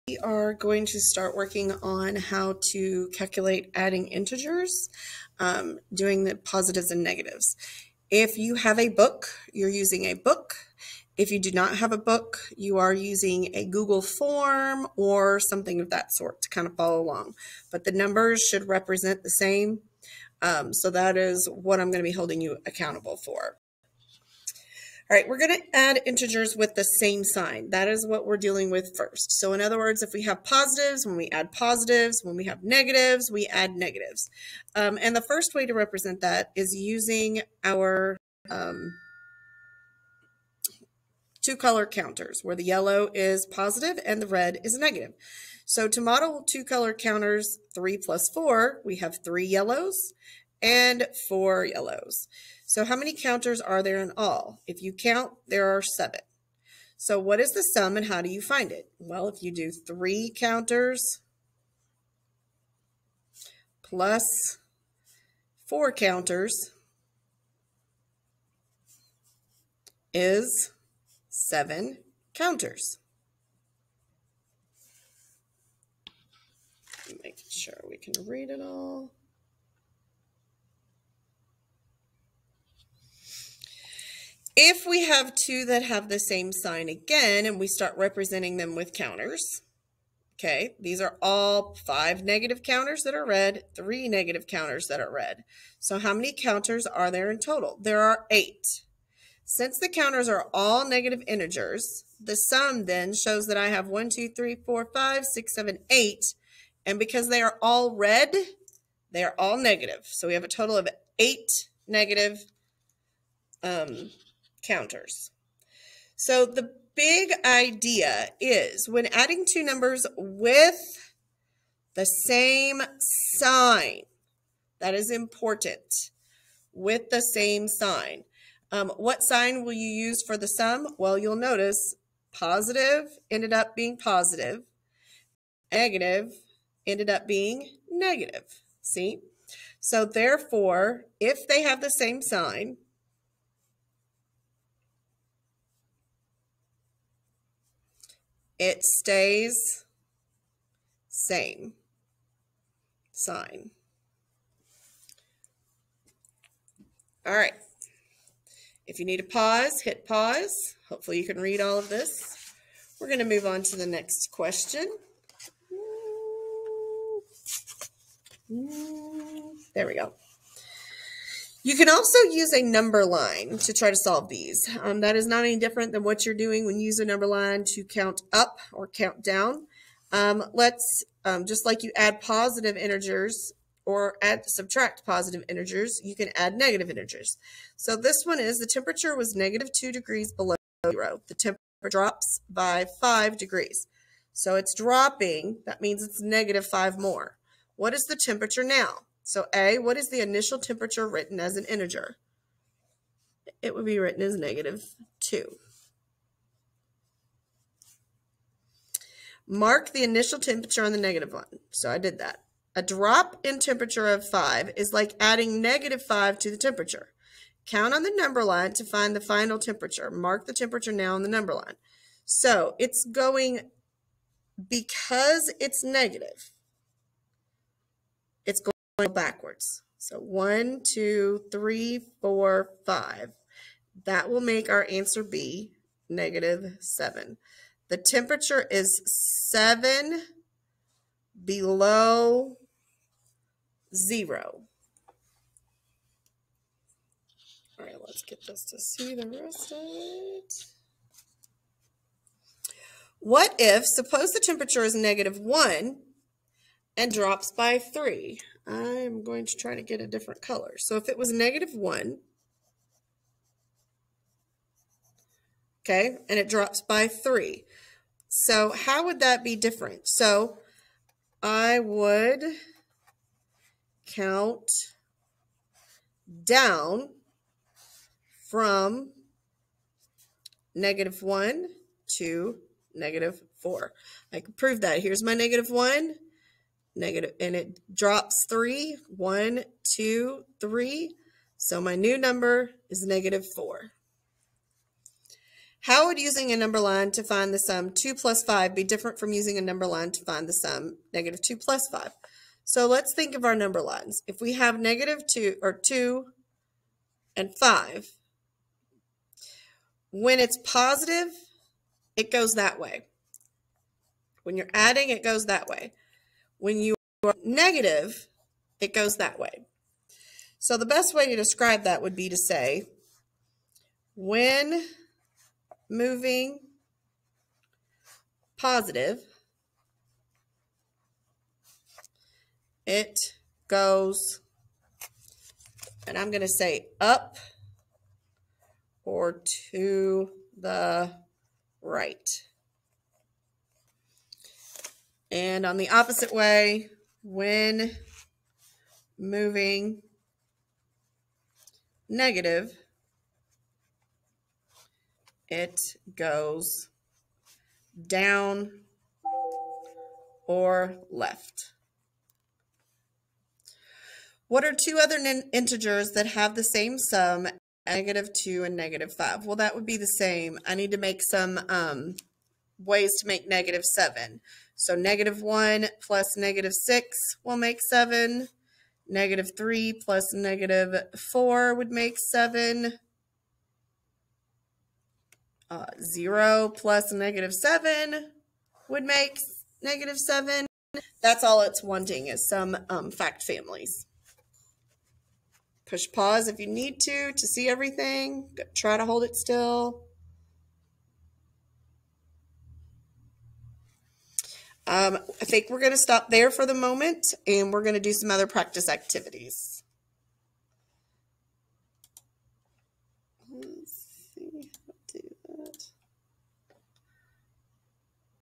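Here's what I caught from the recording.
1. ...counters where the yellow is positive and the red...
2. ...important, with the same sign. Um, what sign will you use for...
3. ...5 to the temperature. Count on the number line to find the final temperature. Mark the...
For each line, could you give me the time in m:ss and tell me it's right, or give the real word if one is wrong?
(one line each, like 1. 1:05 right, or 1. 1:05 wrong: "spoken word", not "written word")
1. 0:41 right
2. 2:05 right
3. 3:36 right.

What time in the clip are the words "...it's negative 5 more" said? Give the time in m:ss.
3:16.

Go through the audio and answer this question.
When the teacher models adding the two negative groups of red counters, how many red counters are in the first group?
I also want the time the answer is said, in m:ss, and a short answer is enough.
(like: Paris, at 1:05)
5, at 1:30.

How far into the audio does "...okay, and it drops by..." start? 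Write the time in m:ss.
4:25.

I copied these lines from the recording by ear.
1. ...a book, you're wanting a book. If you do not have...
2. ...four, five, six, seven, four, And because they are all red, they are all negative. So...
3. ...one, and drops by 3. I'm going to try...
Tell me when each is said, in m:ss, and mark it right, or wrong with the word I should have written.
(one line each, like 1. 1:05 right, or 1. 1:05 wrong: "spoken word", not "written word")
1. 0:08 wrong: "using", not "wanting"
2. 1:44 wrong: "eight", not "four"
3. 4:15 right.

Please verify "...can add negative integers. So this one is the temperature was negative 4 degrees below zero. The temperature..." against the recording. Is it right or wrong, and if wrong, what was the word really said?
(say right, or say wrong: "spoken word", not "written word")
wrong: "2", not "4".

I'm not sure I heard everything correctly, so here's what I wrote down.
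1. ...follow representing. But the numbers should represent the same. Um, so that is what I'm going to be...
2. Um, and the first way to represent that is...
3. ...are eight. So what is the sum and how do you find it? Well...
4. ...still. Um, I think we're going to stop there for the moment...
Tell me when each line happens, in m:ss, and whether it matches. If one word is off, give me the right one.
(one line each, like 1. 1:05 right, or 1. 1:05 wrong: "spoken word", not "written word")
1. 0:16 wrong: "along", not "representing"
2. 0:34 right
3. 0:55 wrong: "seven", not "eight"
4. 6:39 right.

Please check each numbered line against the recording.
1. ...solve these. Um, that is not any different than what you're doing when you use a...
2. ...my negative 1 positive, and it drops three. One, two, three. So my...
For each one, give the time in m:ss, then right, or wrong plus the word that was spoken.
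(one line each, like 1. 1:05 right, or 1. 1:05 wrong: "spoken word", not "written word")
1. 2:53 right
2. 4:45 wrong: "negative", not "positive".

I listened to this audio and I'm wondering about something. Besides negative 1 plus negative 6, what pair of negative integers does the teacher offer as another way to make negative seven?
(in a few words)
-3 and -4.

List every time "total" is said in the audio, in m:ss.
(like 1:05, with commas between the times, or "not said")
1:37, 1:50.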